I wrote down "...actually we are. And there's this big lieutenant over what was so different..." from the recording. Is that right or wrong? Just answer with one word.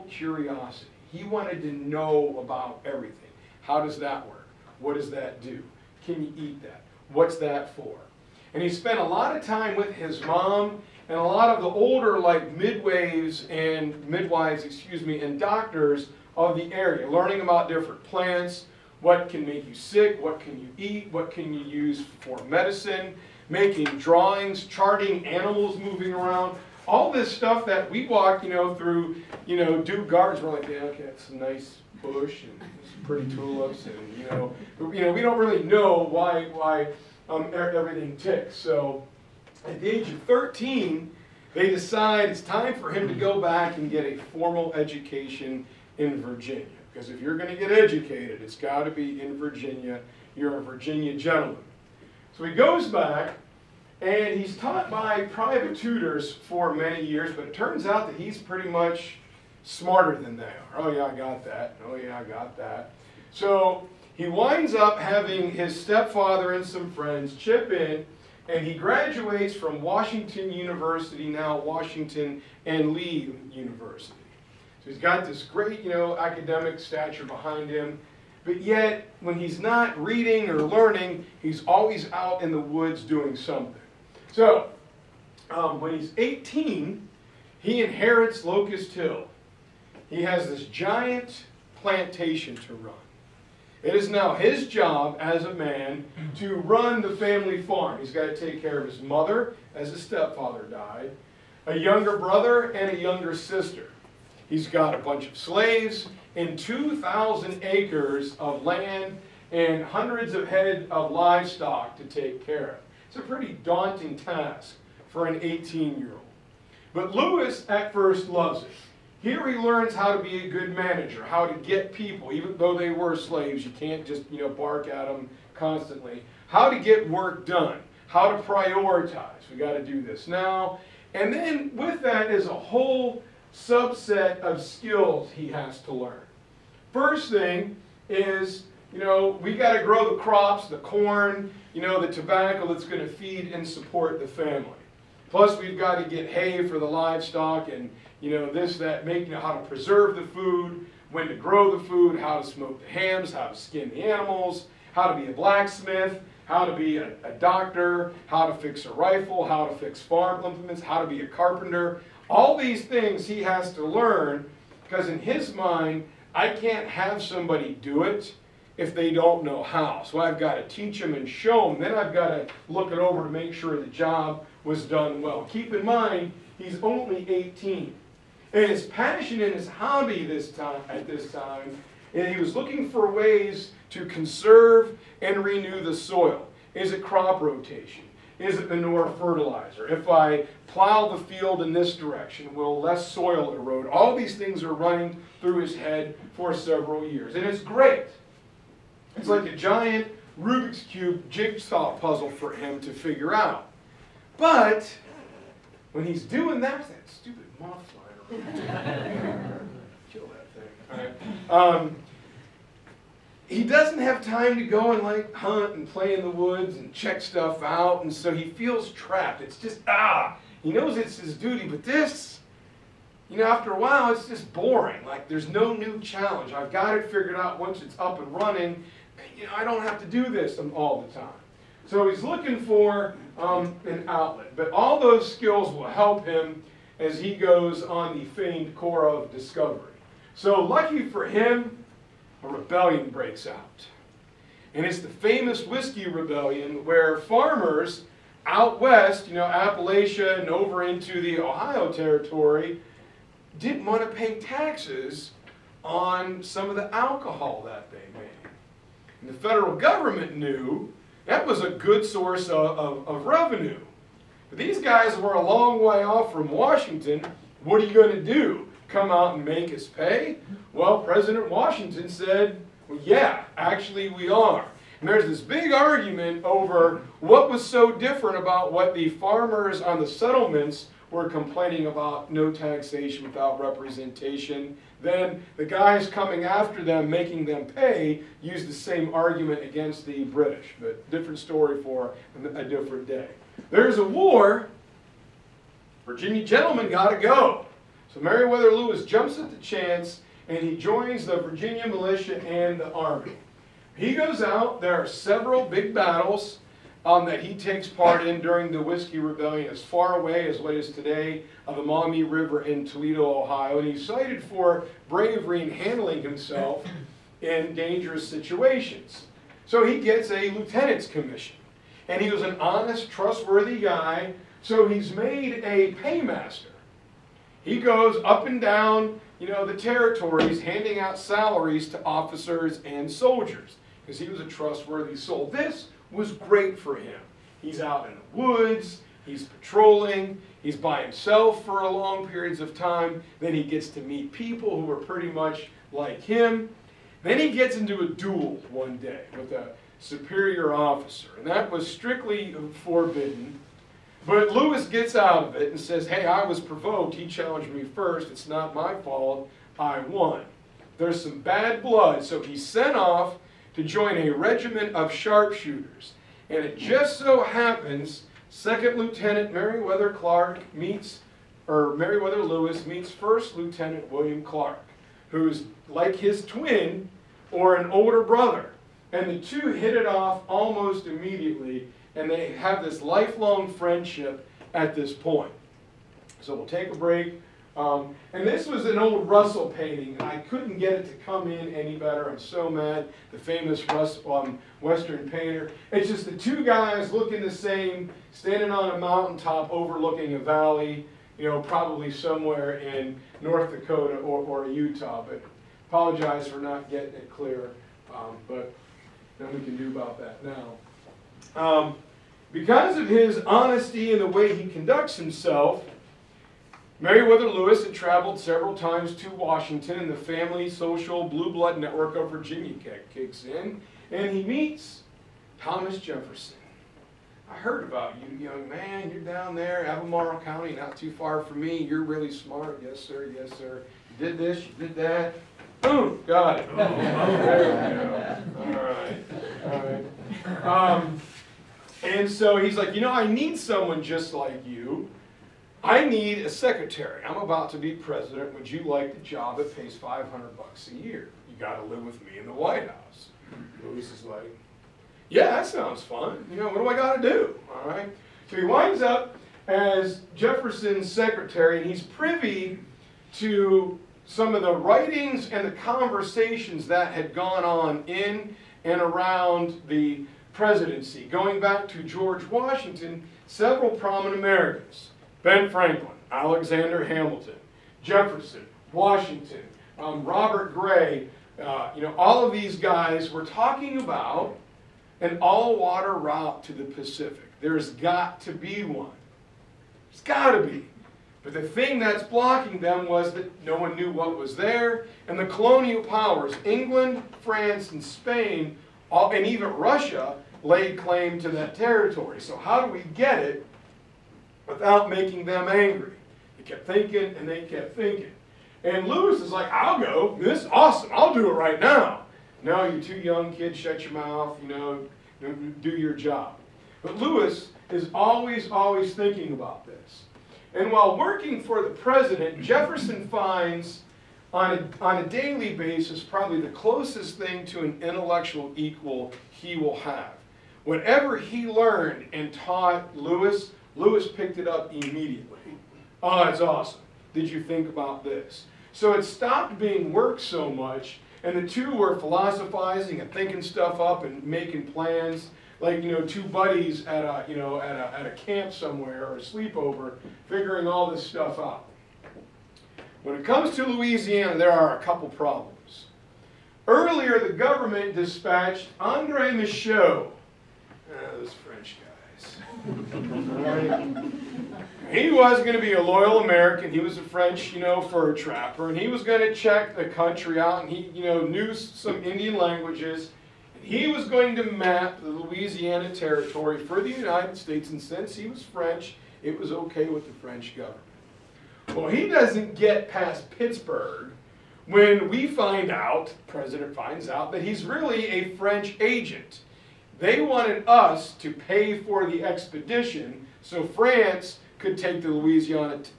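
wrong.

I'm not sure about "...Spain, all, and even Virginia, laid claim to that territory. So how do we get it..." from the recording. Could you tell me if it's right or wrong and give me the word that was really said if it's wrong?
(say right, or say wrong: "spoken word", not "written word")
wrong: "Russia", not "Virginia".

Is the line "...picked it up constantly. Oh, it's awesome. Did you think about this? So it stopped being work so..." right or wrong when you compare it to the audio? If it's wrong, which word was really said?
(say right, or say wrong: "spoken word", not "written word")
wrong: "immediately", not "constantly".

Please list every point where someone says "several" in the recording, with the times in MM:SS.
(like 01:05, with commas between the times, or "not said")
03:16, 05:05, 06:58, 07:53.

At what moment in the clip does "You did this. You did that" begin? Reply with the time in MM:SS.
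07:14.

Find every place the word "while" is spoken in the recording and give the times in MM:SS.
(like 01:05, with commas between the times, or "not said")
03:43, 08:40.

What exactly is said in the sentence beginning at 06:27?
Um, and this was an old Russell painting.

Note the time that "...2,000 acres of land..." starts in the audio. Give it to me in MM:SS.
01:46.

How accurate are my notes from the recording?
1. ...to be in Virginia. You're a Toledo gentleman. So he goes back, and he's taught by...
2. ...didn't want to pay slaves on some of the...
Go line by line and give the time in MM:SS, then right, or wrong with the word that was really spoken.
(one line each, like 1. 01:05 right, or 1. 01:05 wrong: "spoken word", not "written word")
1. 00:48 wrong: "Virginia", not "Toledo"
2. 04:13 wrong: "taxes", not "slaves".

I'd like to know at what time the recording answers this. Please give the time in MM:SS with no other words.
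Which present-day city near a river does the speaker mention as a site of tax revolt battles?
05:12.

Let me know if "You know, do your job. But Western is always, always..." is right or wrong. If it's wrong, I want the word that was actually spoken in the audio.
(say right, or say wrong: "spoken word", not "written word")
wrong: "Lewis", not "Western".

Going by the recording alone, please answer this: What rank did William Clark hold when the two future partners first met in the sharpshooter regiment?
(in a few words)
First Lieutenant.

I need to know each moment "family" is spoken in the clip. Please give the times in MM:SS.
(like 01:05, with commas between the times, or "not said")
01:37, 02:24, 07:00.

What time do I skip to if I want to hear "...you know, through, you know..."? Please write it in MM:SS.
00:28.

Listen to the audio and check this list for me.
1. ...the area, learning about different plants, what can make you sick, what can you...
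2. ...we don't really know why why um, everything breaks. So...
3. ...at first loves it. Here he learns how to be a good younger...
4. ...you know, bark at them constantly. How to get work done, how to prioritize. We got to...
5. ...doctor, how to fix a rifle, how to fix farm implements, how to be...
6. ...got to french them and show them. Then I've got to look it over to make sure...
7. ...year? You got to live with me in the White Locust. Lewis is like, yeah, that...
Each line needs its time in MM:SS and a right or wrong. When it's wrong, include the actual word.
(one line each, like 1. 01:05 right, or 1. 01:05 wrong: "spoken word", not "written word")
1. 00:16 right
2. 00:35 wrong: "ticks", not "breaks"
3. 01:57 wrong: "manager", not "younger"
4. 02:04 right
5. 02:37 right
6. 02:50 wrong: "teach", not "french"
7. 07:30 wrong: "House", not "Locust".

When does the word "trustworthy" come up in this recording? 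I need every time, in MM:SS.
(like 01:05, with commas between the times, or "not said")
05:23, 05:34.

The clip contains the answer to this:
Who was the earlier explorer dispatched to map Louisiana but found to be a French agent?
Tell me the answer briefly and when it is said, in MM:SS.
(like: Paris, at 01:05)
Andre Michaux, at 09:18.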